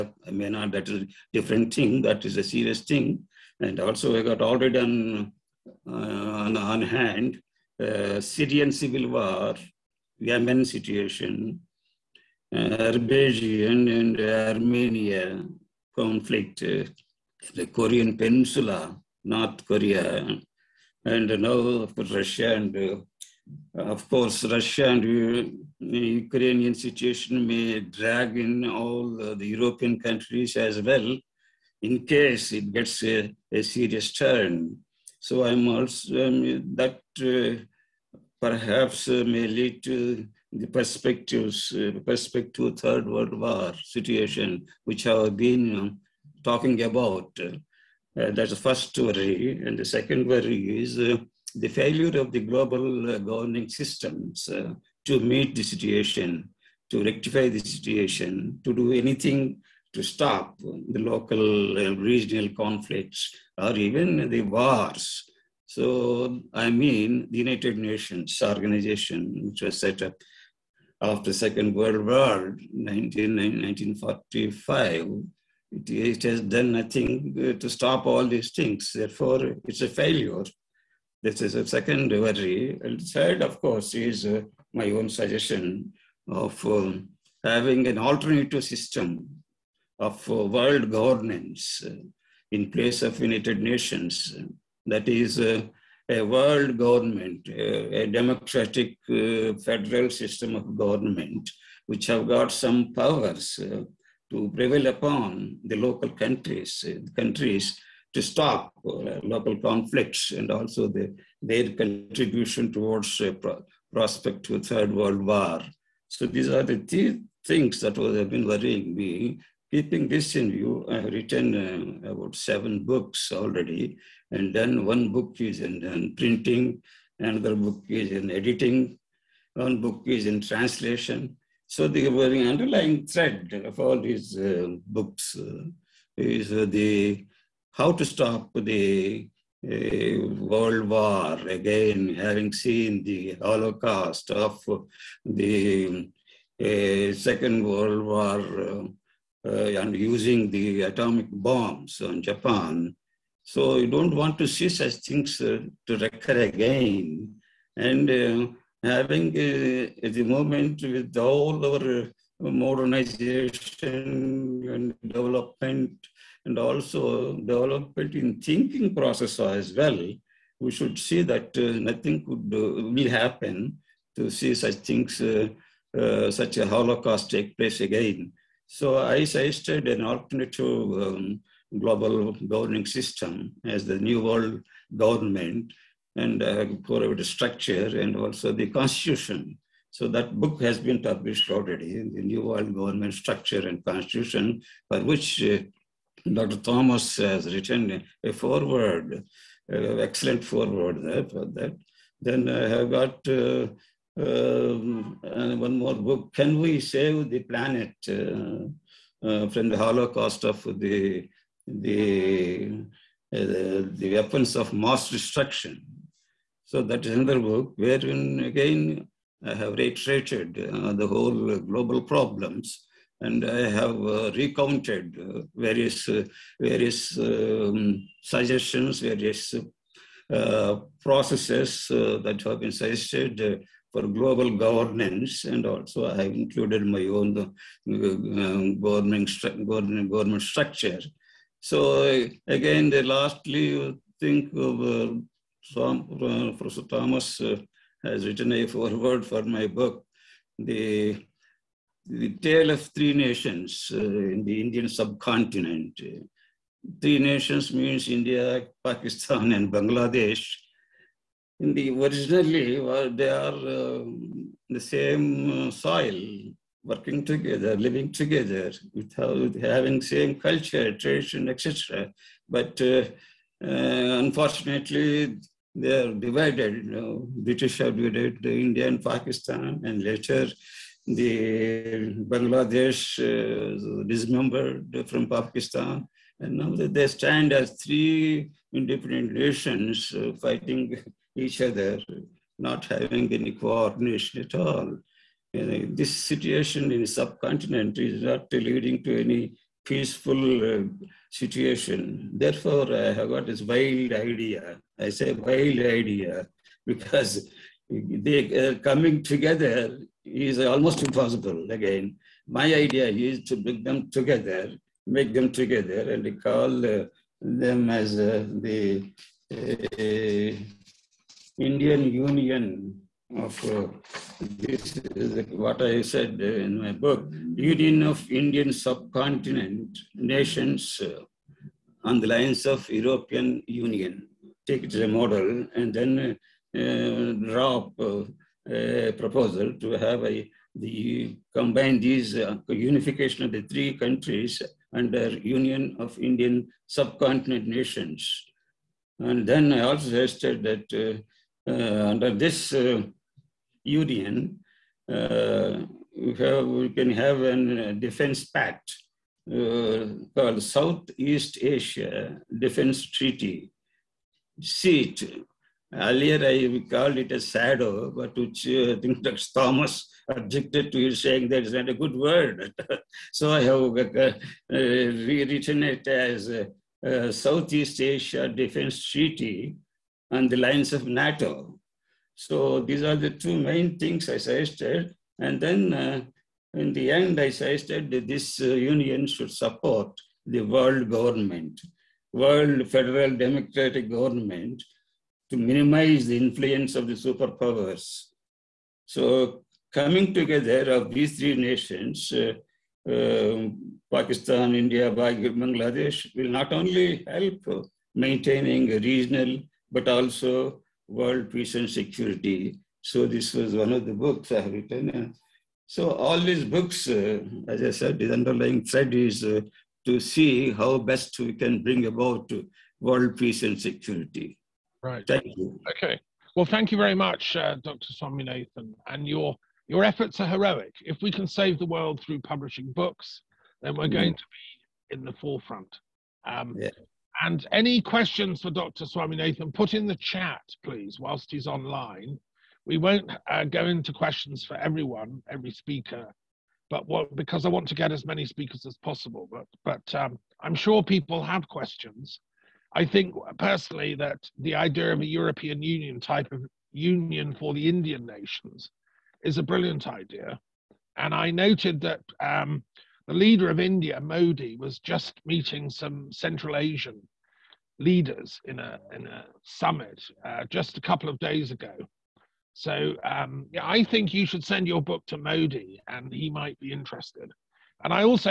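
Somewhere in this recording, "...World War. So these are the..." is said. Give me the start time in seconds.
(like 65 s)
114 s.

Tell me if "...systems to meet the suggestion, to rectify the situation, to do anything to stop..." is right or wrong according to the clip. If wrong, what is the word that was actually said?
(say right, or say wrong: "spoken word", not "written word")
wrong: "situation", not "suggestion".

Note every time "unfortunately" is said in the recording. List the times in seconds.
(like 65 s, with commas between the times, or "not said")
274 s.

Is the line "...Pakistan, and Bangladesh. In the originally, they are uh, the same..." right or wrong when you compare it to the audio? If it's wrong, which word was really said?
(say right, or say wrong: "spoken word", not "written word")
right.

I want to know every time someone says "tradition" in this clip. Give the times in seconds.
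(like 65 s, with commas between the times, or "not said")
270 s.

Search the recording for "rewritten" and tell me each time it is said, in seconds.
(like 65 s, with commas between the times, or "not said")
374 s.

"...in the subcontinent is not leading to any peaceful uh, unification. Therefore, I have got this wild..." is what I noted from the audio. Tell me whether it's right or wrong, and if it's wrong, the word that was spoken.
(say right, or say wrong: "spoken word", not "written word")
wrong: "situation", not "unification".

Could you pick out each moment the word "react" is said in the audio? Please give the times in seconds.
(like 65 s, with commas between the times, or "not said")
not said.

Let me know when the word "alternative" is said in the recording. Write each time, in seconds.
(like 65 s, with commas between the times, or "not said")
87 s, 180 s.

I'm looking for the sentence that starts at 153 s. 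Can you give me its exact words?
So you don't want to see such things to recur again.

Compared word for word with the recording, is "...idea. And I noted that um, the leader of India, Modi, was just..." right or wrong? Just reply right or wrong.
right.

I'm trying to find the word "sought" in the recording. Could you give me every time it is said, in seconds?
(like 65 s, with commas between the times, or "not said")
not said.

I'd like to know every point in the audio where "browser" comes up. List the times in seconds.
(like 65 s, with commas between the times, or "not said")
not said.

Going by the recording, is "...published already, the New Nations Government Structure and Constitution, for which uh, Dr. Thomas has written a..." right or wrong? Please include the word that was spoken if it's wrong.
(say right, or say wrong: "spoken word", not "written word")
wrong: "World", not "Nations".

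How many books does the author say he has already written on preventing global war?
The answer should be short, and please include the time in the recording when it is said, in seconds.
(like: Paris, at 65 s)
seven, at 122 s.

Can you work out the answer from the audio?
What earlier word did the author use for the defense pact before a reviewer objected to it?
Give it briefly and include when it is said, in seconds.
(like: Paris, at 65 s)
shadow, at 367 s.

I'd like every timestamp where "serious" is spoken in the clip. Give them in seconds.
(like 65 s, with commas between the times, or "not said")
2 s, 33 s.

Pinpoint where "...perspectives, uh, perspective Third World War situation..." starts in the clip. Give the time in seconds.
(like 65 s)
40 s.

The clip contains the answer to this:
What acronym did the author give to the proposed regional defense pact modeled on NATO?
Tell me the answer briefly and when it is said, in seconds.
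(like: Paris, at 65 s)
SEAT, at 364 s.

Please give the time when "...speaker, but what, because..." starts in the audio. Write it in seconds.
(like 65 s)
445 s.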